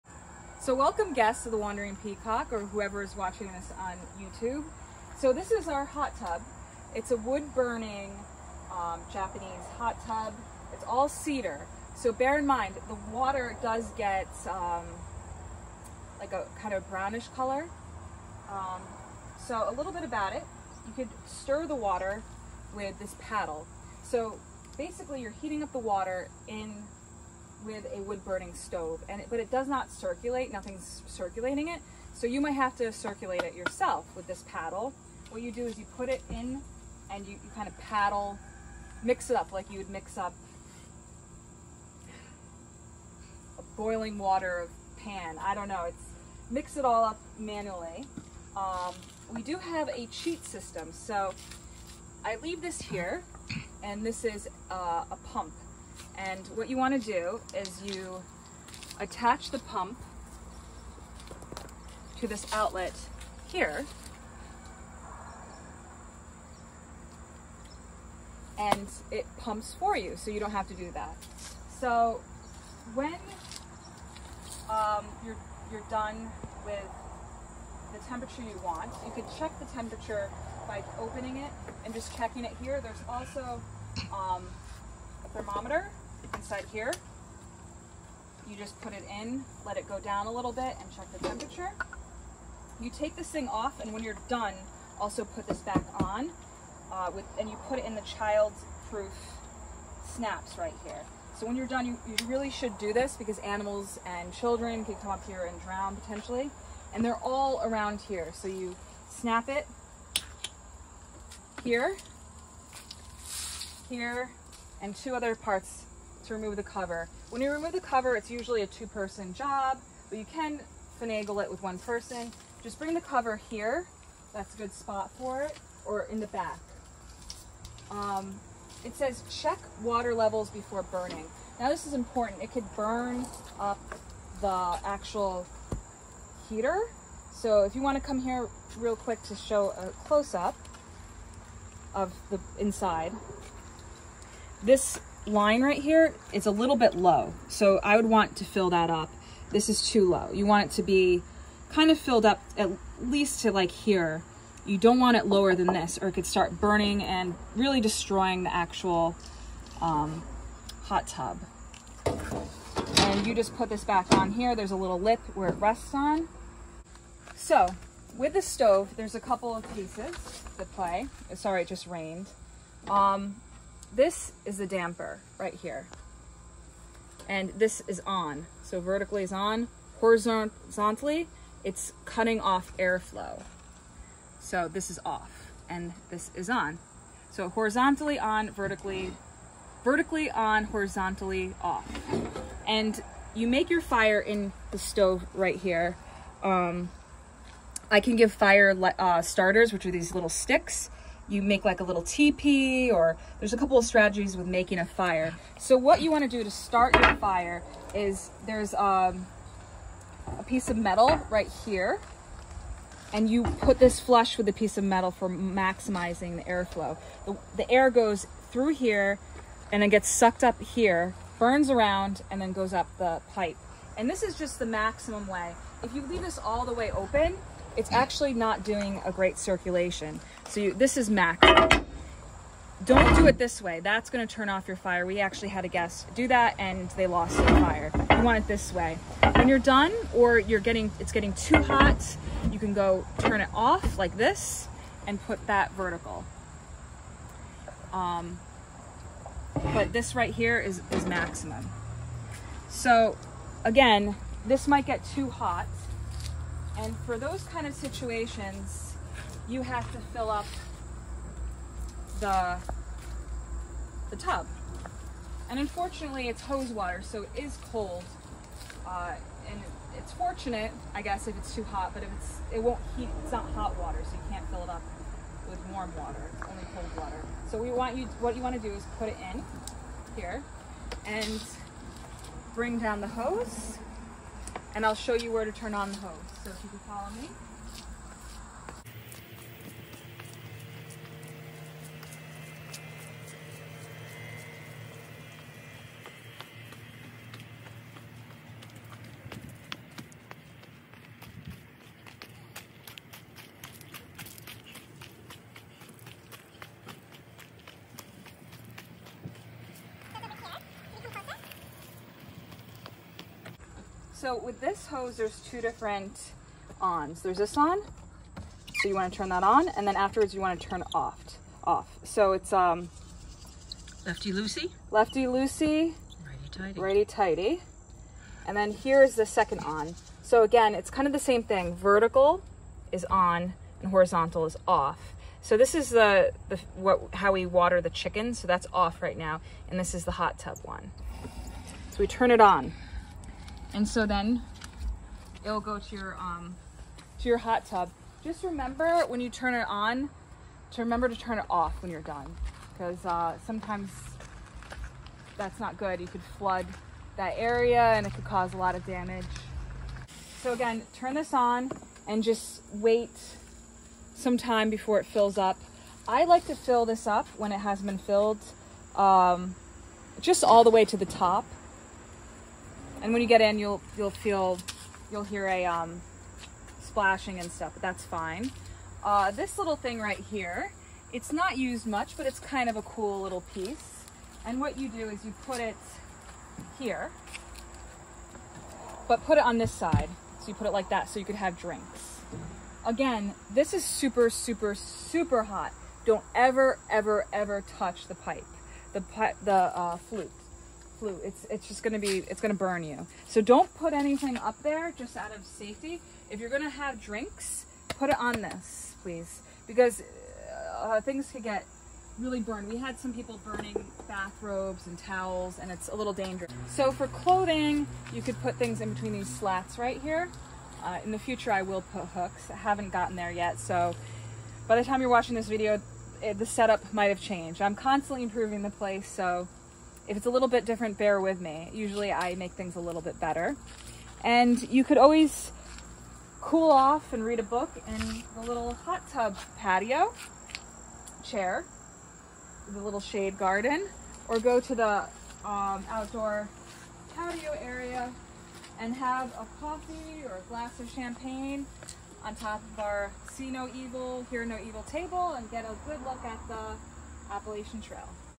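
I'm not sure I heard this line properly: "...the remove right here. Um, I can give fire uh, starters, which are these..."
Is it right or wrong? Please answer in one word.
wrong.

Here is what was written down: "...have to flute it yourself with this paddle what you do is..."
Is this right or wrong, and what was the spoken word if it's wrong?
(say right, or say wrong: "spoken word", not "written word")
wrong: "circulate", not "flute".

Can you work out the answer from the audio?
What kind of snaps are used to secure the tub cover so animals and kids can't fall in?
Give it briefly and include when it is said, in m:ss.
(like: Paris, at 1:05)
Child-proof snaps, at 1:38.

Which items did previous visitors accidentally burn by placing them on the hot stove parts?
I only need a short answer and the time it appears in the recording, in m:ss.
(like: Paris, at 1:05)
Bathrobes and towels, at 6:54.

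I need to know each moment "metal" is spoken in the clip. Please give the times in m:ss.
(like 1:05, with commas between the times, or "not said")
3:30, 3:34.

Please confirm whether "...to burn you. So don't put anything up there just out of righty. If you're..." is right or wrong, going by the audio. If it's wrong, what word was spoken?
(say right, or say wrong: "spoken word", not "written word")
wrong: "safety", not "righty".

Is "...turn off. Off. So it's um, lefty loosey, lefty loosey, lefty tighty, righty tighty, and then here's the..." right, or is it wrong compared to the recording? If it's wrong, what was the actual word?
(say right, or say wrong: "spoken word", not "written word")
wrong: "righty", not "lefty".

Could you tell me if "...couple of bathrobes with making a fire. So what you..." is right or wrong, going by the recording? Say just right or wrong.
wrong.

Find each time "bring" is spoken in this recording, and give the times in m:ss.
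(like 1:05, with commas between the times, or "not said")
2:02, 4:42.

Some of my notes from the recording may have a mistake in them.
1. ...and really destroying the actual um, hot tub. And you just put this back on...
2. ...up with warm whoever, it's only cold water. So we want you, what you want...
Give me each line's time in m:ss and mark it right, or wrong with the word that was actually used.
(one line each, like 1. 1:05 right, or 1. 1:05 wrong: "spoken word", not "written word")
1. 2:37 right
2. 4:34 wrong: "water", not "whoever".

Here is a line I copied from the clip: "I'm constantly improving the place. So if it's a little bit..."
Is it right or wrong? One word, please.
right.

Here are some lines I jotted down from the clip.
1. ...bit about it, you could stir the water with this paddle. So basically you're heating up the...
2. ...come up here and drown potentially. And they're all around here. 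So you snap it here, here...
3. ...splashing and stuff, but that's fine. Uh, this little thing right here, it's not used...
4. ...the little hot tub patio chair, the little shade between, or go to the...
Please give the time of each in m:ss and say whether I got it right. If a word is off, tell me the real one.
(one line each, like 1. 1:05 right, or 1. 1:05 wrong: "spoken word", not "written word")
1. 0:19 right
2. 1:44 right
3. 6:16 right
4. 7:18 wrong: "garden", not "between".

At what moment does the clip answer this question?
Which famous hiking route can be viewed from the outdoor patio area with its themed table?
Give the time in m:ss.
7:37.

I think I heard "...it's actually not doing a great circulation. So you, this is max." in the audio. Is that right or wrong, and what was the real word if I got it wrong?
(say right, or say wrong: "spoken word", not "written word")
right.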